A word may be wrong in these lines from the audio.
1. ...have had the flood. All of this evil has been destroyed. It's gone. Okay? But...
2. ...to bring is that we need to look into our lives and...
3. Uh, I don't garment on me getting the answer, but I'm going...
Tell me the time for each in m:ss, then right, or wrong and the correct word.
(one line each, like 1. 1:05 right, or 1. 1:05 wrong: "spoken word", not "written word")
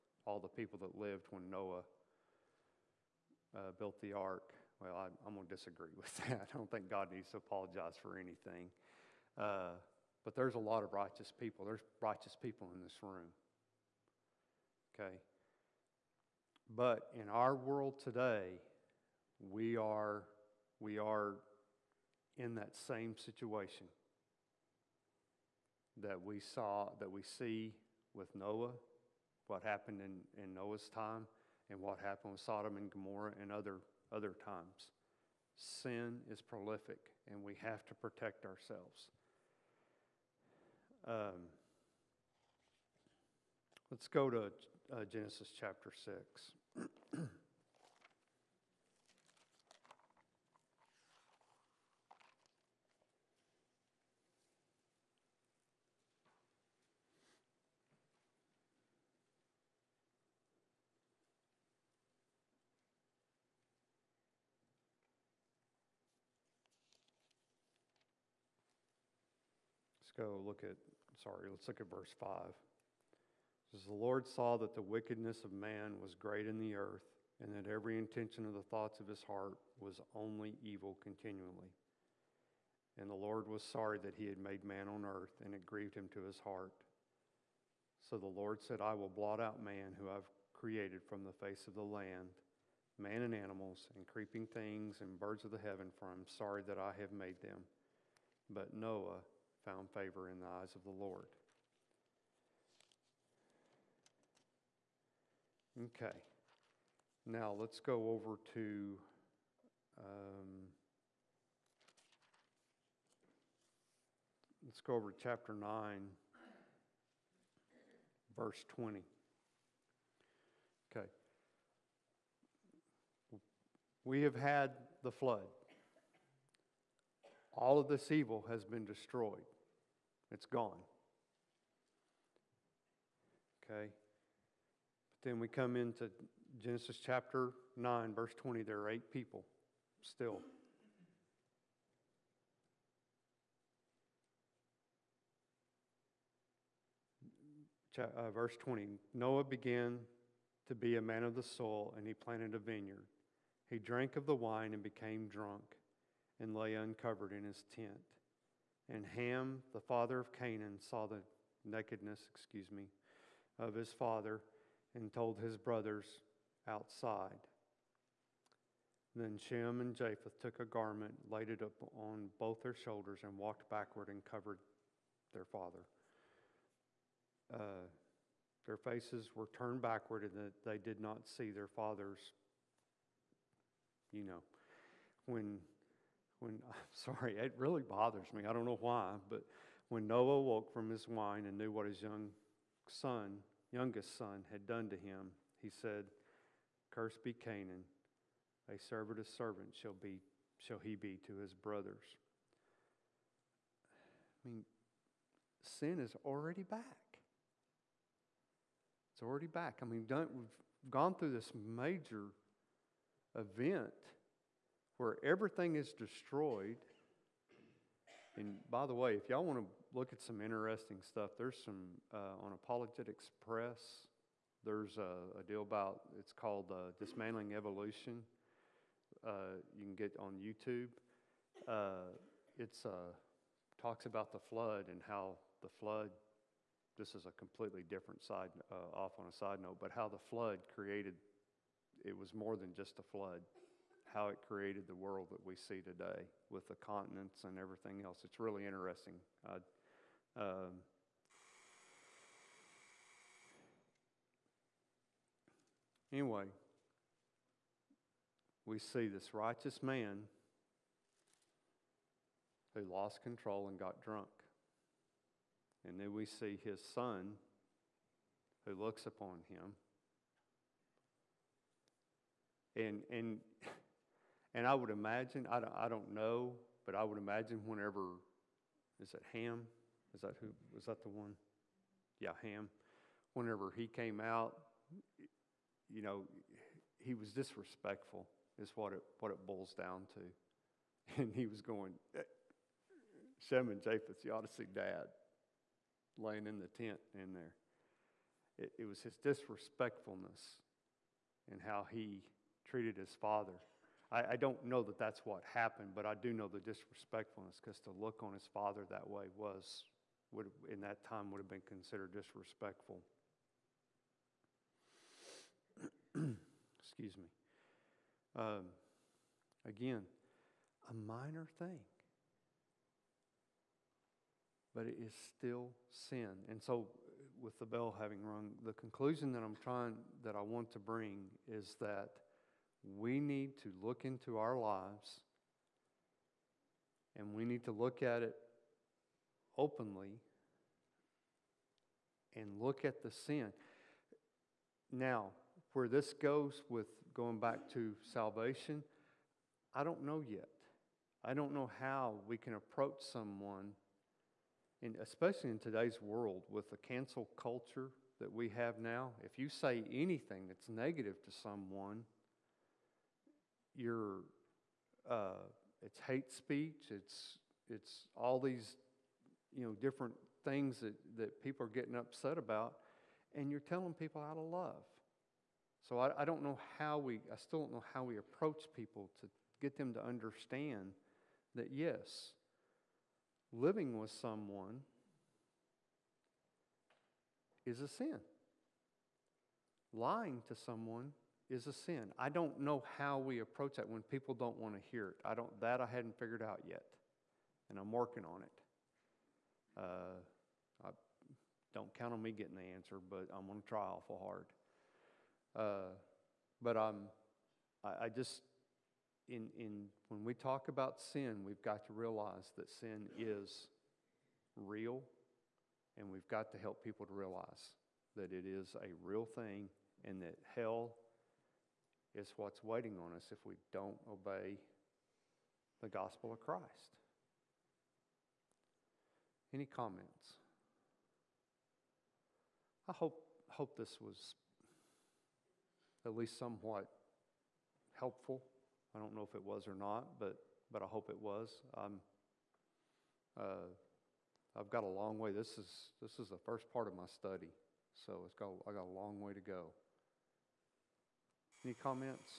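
1. 2:04 right
2. 5:30 right
3. 6:39 wrong: "count", not "garment".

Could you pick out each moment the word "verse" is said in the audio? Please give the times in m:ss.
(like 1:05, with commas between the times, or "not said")
1:11, 1:58, 2:18, 2:28.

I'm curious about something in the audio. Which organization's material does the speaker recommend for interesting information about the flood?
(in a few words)
Apologetics Press.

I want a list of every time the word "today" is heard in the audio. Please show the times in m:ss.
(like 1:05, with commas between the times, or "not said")
0:18, 4:05, 5:55.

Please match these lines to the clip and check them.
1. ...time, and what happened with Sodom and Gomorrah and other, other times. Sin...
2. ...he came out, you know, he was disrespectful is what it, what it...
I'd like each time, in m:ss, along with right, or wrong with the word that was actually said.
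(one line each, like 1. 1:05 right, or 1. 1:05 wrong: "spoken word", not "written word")
1. 0:30 right
2. 4:43 right.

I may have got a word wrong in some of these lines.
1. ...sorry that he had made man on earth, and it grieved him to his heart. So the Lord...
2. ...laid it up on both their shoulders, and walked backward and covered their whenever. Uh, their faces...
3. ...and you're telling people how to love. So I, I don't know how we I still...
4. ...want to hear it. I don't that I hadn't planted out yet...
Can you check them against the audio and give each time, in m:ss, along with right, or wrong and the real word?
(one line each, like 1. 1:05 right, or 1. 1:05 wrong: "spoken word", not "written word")
1. 1:23 right
2. 2:51 wrong: "father", not "whenever"
3. 6:13 right
4. 6:34 wrong: "figured", not "planted".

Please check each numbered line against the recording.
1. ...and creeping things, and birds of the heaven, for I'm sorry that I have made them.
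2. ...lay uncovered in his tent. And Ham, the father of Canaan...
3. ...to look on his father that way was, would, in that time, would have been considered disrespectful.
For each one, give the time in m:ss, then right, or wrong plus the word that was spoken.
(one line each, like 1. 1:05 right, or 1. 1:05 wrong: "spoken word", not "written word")
1. 1:33 right
2. 2:36 right
3. 5:07 right.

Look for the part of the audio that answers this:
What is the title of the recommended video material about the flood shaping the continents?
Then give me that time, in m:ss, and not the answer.
3:46.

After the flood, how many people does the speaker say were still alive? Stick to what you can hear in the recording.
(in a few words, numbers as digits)
8.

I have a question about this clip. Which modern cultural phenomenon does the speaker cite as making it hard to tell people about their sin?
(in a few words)
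Cancel culture.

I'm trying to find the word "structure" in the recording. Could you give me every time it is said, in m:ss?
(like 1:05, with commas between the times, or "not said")
not said.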